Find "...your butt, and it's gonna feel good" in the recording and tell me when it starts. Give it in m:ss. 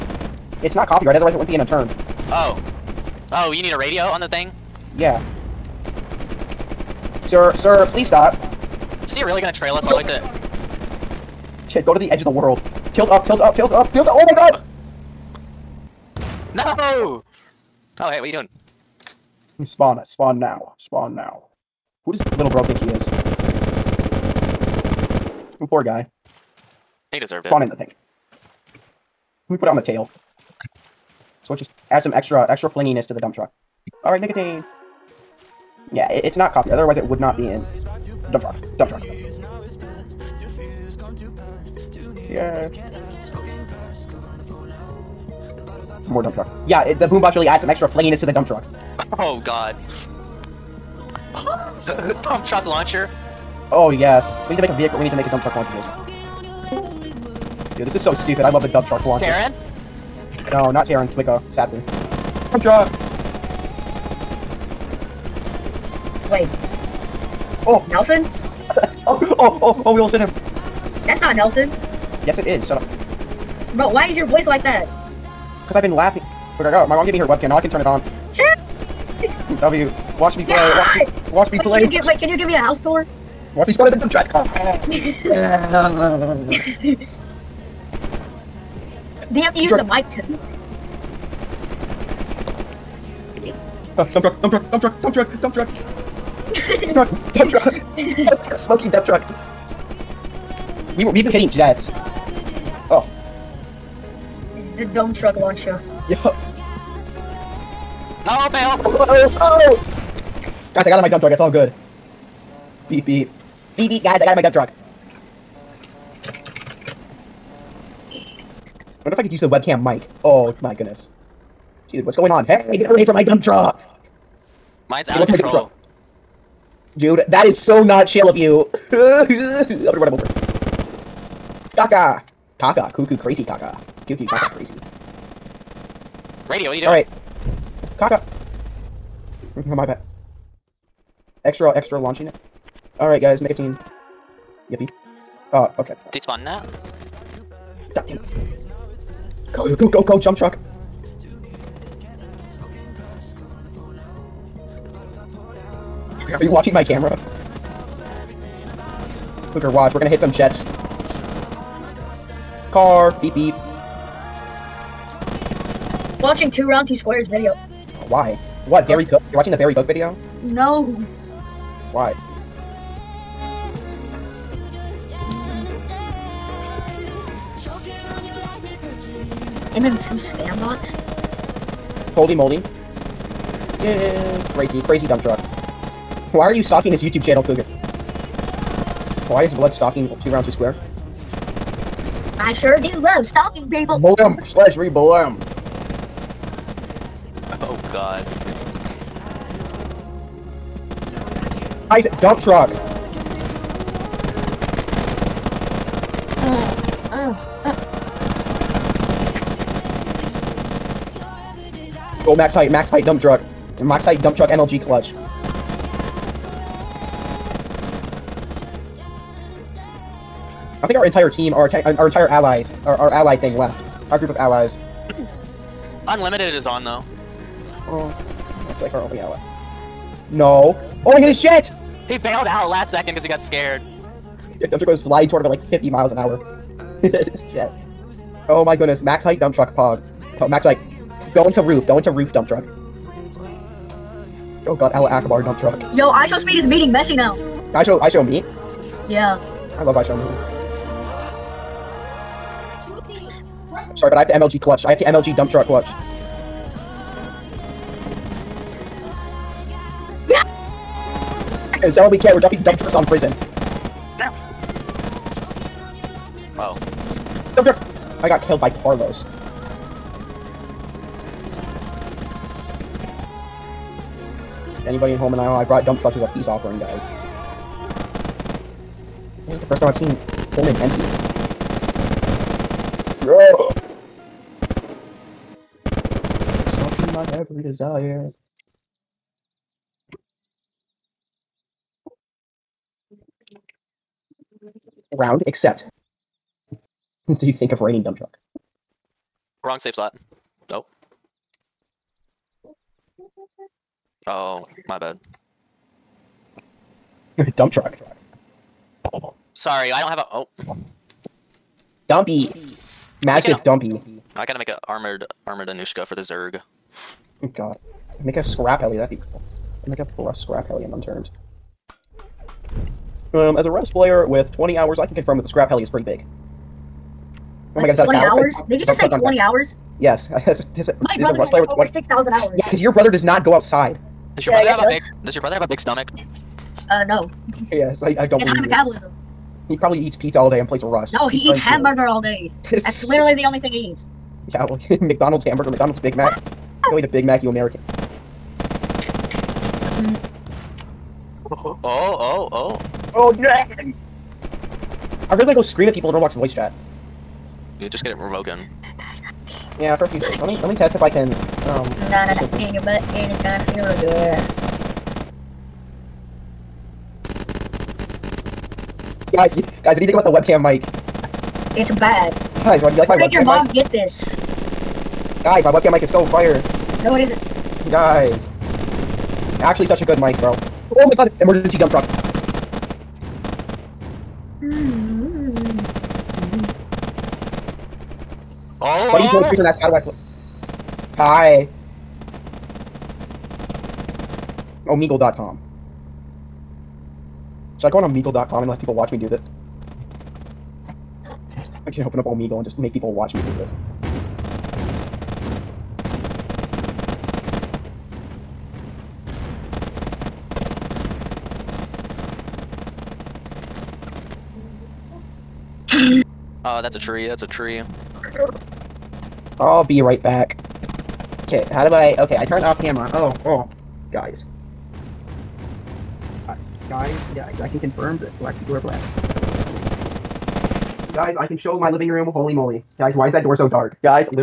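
6:02.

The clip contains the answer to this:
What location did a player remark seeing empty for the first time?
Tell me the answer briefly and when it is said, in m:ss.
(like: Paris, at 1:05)
Pullman, at 4:40.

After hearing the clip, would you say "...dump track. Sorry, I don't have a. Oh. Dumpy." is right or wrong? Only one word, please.
wrong.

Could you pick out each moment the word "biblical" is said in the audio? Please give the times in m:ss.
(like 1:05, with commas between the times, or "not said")
not said.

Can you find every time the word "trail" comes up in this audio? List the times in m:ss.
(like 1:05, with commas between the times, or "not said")
0:09.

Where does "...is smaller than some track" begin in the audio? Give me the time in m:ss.
1:23.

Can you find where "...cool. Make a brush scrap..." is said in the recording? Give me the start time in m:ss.
5:19.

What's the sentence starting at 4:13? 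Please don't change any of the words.
Sorry, but I have to MLG clutch.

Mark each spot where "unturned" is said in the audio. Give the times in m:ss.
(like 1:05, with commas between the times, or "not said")
0:01, 5:20.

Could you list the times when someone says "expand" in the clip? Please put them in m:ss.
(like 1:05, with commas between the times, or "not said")
not said.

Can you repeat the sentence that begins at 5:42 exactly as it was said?
That's literally the only thing he eats.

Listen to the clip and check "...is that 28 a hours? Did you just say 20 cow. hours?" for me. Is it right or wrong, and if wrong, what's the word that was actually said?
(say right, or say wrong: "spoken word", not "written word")
wrong: "20", not "28".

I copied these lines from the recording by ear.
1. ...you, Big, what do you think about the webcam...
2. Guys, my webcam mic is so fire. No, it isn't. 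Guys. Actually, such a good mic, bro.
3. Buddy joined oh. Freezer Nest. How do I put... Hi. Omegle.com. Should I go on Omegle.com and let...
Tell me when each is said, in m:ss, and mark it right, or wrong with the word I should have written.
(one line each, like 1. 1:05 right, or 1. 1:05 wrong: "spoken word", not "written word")
1. 6:09 wrong: "Guys", not "Big"
2. 6:15 right
3. 6:29 right.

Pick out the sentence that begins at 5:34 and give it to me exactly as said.
Does your yeah, brother have a does.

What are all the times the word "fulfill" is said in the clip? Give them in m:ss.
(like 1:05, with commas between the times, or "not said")
not said.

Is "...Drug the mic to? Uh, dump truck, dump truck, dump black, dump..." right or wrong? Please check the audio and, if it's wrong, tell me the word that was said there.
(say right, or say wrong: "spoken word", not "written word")
wrong: "truck", not "black".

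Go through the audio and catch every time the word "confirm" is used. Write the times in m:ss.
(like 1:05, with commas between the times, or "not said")
5:25, 7:07.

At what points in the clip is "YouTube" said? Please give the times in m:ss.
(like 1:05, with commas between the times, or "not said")
3:07.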